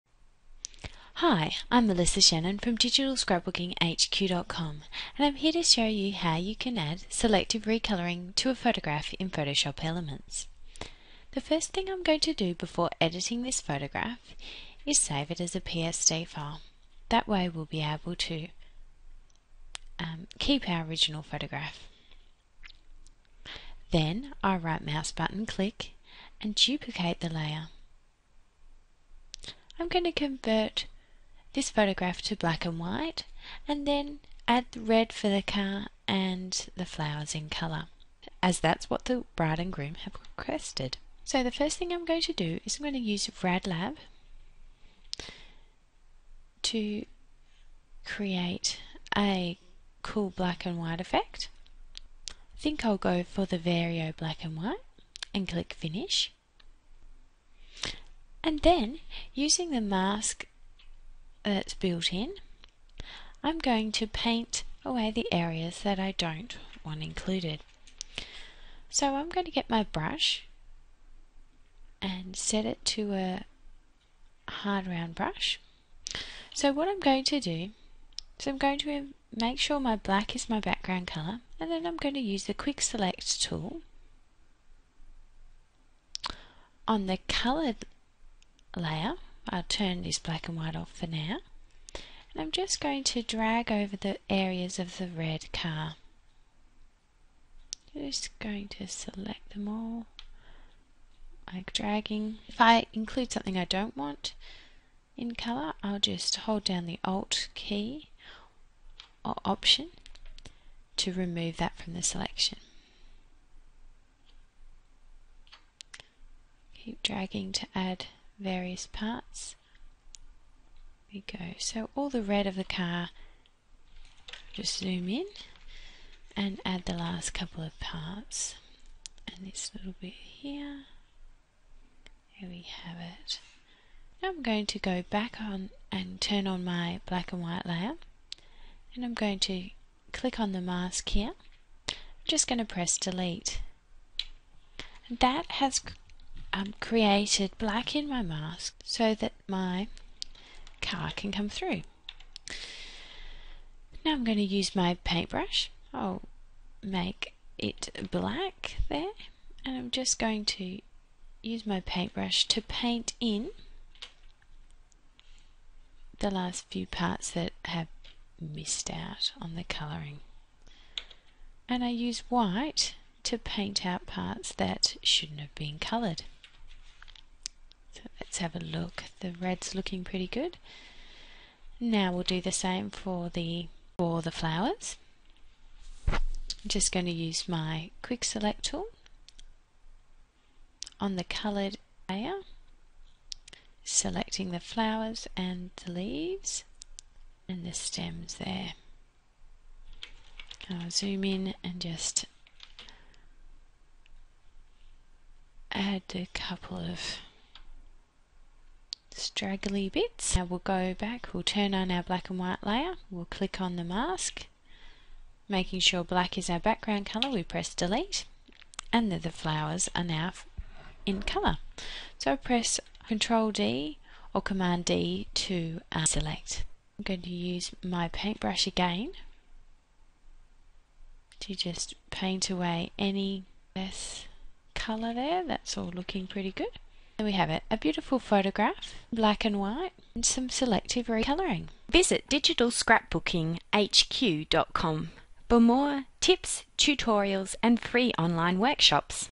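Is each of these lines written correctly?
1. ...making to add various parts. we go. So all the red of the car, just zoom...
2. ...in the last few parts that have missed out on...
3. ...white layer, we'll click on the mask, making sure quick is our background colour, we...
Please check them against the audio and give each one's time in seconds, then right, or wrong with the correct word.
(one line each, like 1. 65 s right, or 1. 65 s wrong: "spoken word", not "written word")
1. 117 s wrong: "dragging", not "making"
2. 163 s right
3. 212 s wrong: "black", not "quick".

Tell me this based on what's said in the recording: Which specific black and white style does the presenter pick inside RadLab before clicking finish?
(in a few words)
Vario.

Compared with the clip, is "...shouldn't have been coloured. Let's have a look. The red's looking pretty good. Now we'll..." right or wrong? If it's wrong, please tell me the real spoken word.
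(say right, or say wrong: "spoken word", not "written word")
right.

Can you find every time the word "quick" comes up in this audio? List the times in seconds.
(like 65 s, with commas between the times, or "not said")
82 s, 188 s.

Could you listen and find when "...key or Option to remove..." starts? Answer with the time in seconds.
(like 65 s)
107 s.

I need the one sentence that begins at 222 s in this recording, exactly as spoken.
So press Ctrl D or Command D to uh, select.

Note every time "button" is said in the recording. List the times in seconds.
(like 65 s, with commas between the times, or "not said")
25 s.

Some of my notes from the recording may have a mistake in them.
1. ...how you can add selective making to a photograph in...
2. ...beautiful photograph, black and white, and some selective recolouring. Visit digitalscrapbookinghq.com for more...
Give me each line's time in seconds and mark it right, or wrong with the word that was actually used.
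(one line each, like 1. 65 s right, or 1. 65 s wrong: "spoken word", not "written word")
1. 6 s wrong: "recoloring", not "making"
2. 237 s right.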